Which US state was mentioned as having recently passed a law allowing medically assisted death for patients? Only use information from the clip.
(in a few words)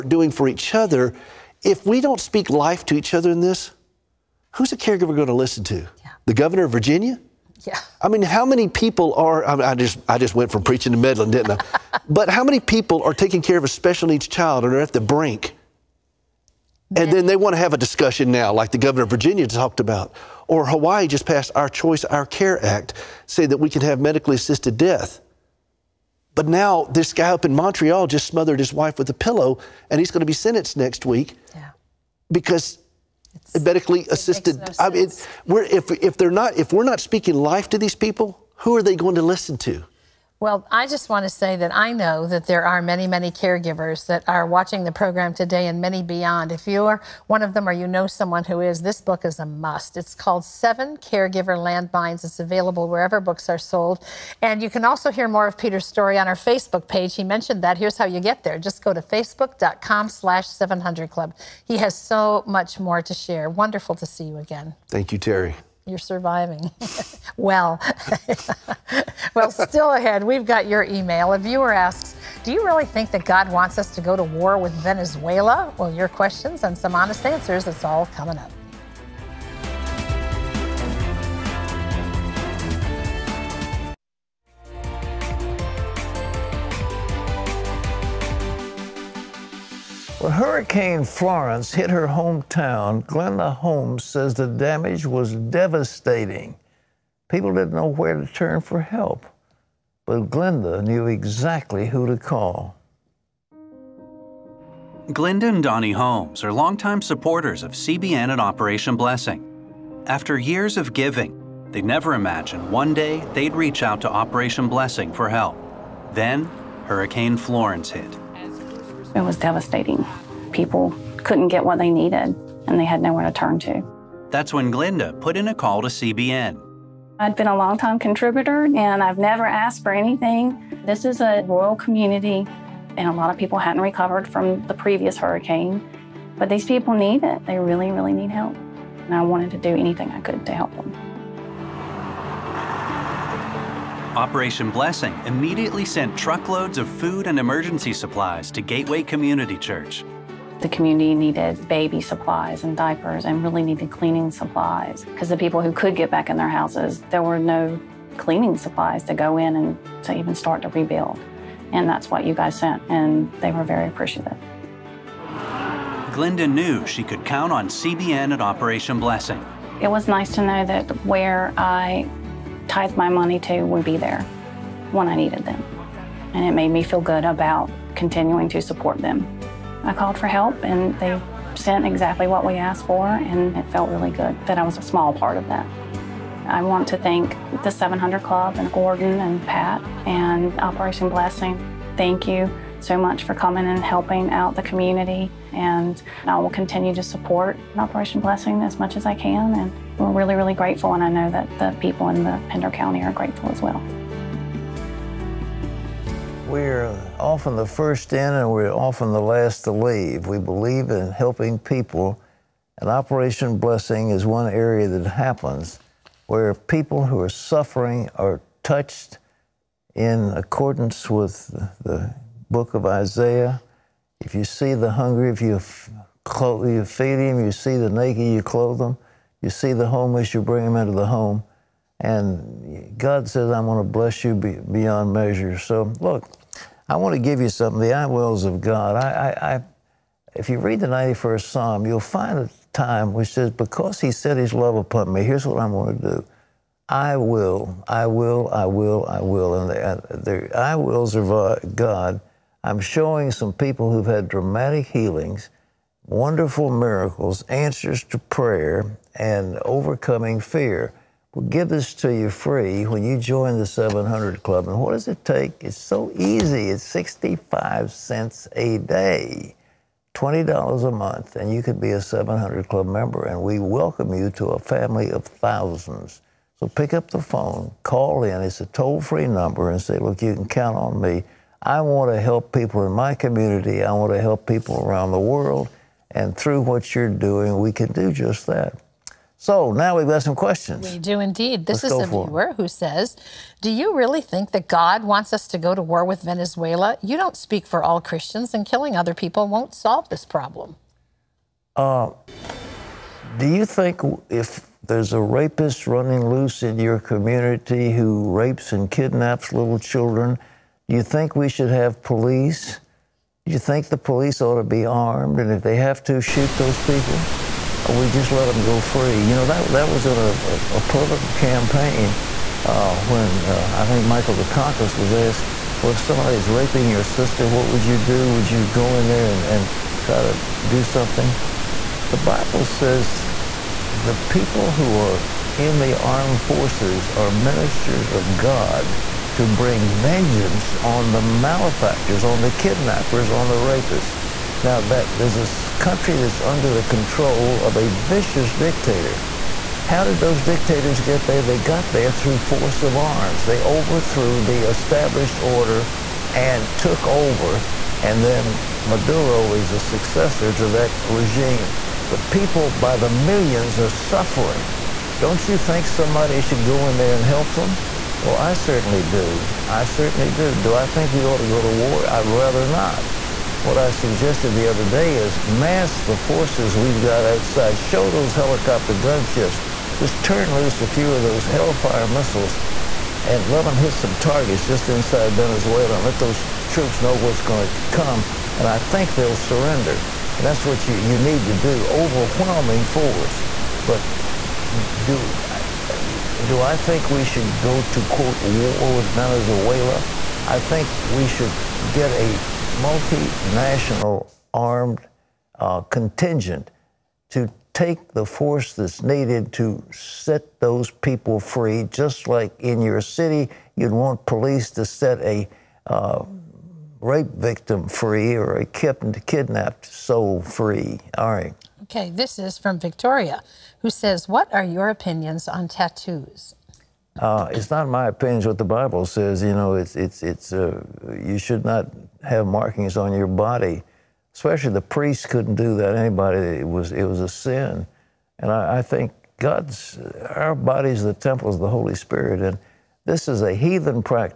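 Hawaii.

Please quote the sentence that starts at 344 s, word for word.
Now, that, there's a country that's under the control of a vicious dictator.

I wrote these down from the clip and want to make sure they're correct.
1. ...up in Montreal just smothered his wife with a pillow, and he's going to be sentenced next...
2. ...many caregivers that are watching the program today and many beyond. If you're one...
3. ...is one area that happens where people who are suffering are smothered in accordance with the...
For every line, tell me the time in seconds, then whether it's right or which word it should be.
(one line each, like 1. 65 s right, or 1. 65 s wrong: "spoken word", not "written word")
1. 27 s right
2. 43 s right
3. 214 s wrong: "touched", not "smothered".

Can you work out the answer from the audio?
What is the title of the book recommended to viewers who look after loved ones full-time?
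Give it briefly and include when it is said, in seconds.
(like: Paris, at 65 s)
Seven Caregiver Landmines, at 50 s.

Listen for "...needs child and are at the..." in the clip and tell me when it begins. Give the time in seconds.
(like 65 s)
14 s.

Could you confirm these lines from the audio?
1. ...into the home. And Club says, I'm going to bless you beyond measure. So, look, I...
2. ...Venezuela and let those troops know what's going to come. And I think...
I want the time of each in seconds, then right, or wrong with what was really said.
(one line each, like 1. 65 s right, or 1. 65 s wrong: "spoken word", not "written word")
1. 230 s wrong: "God", not "Club"
2. 385 s right.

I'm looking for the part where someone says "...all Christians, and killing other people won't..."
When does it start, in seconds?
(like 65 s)
297 s.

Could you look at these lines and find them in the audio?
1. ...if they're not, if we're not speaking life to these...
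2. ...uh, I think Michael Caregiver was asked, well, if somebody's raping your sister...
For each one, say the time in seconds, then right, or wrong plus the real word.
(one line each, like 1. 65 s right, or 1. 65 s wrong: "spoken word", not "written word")
1. 35 s right
2. 323 s wrong: "Dukakis", not "Caregiver".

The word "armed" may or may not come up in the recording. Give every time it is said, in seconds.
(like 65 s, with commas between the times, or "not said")
314 s, 335 s, 404 s.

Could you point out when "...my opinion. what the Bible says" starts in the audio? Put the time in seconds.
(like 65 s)
427 s.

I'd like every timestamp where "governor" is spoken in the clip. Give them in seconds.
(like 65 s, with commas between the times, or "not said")
6 s, 18 s.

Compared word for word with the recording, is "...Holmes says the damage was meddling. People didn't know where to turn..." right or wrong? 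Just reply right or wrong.
wrong.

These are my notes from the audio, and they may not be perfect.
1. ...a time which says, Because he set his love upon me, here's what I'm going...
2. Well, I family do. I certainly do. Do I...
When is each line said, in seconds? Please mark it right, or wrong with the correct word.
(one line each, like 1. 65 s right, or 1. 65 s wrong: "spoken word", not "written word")
1. 242 s right
2. 368 s wrong: "certainly", not "family".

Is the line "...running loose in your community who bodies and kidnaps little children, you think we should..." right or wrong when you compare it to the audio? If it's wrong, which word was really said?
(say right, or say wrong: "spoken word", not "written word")
wrong: "rapes", not "bodies".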